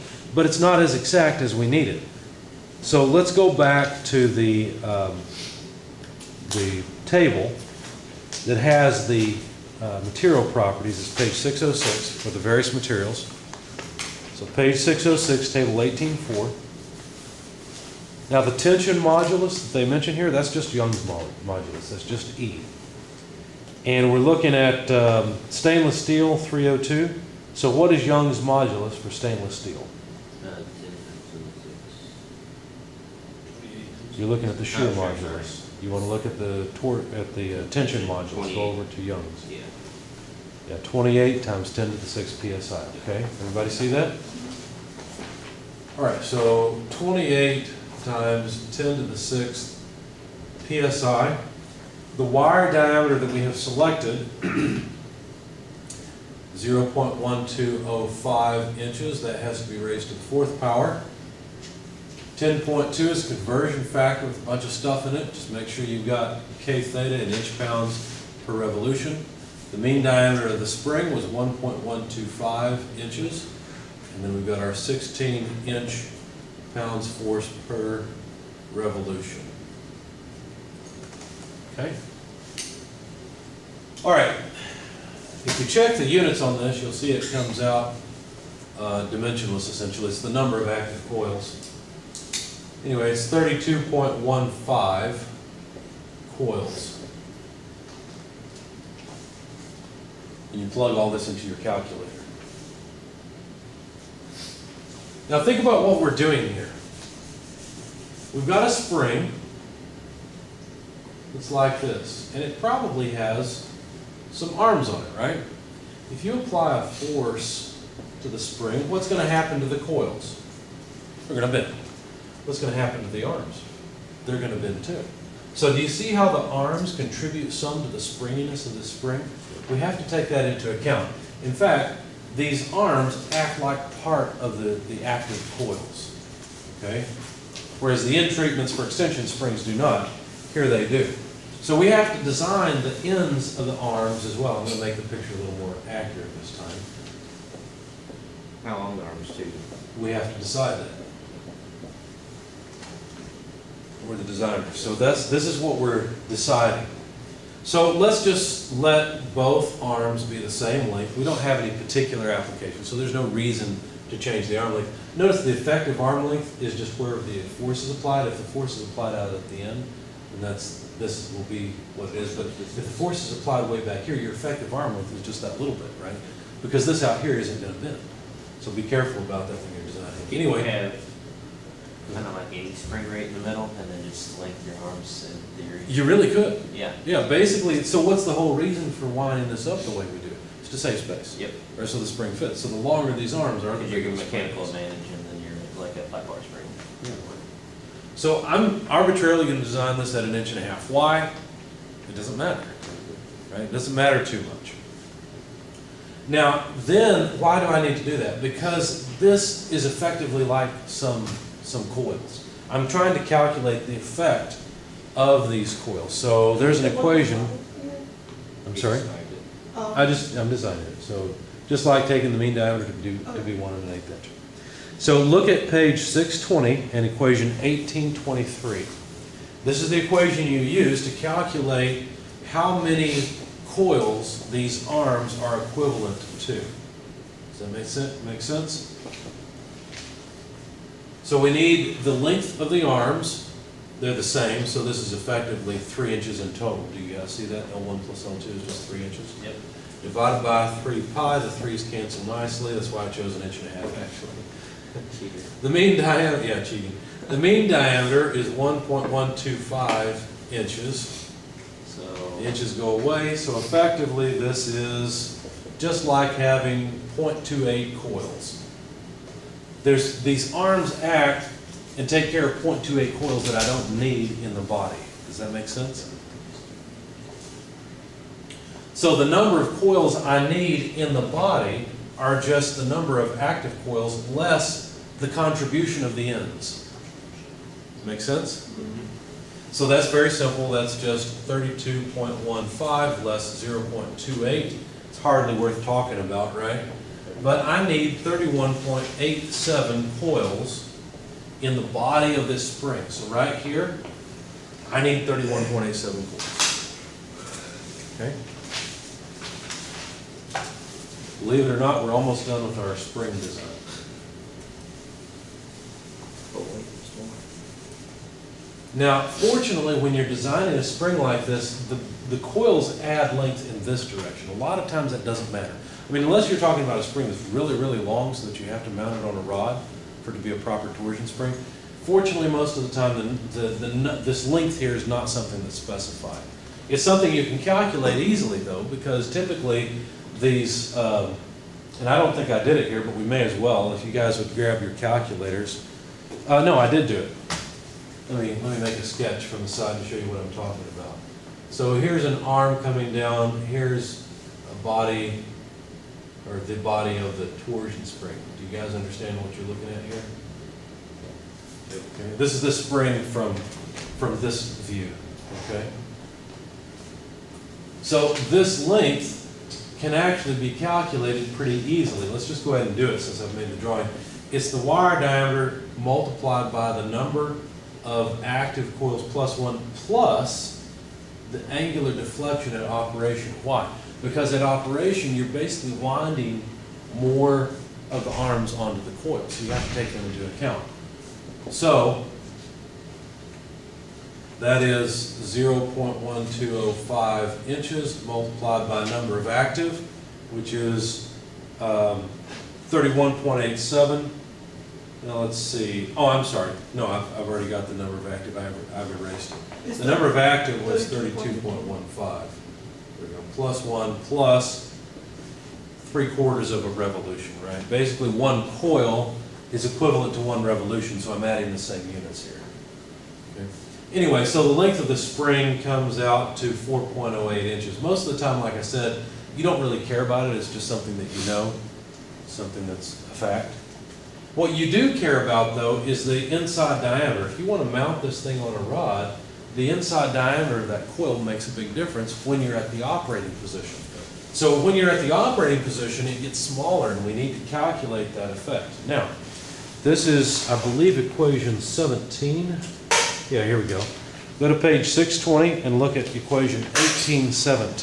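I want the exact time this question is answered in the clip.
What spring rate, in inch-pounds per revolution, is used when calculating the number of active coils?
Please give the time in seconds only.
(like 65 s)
74 s.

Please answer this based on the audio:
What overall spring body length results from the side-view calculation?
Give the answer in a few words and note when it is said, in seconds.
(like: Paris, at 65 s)
4.08 inches, at 426 s.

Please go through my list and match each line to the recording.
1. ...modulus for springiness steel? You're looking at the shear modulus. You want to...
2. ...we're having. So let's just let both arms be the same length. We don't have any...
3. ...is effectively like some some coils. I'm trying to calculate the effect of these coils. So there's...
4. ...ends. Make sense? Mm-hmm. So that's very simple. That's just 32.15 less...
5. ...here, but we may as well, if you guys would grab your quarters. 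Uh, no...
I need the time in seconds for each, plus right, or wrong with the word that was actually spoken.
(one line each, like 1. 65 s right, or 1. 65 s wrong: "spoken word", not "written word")
1. 28 s wrong: "stainless", not "springiness"
2. 155 s wrong: "deciding", not "having"
3. 209 s right
4. 286 s right
5. 342 s wrong: "calculators", not "quarters".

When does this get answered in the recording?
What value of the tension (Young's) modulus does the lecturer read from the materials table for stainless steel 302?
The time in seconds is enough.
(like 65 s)
40 s.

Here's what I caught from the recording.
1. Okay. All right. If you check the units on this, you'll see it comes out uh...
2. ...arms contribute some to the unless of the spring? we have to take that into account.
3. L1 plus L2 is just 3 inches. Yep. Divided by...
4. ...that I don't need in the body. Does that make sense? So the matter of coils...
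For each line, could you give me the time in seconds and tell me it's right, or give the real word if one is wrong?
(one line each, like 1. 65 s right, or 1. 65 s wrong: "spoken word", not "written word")
1. 81 s right
2. 126 s wrong: "springiness", not "unless"
3. 247 s right
4. 273 s wrong: "number", not "matter".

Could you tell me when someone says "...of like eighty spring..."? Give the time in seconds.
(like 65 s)
182 s.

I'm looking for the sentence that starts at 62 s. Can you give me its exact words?
10.2 is conversion factor with a bunch of stuff in it.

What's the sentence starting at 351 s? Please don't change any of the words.
So here's an arm coming down, here's a body, or the body of the torsion spring.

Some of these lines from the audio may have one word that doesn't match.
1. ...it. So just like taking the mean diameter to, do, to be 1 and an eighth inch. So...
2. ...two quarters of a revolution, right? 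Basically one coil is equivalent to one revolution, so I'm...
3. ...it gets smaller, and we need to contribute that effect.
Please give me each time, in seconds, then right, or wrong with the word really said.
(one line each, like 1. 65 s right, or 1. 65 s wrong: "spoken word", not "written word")
1. 220 s right
2. 416 s wrong: "three", not "two"
3. 446 s wrong: "calculate", not "contribute".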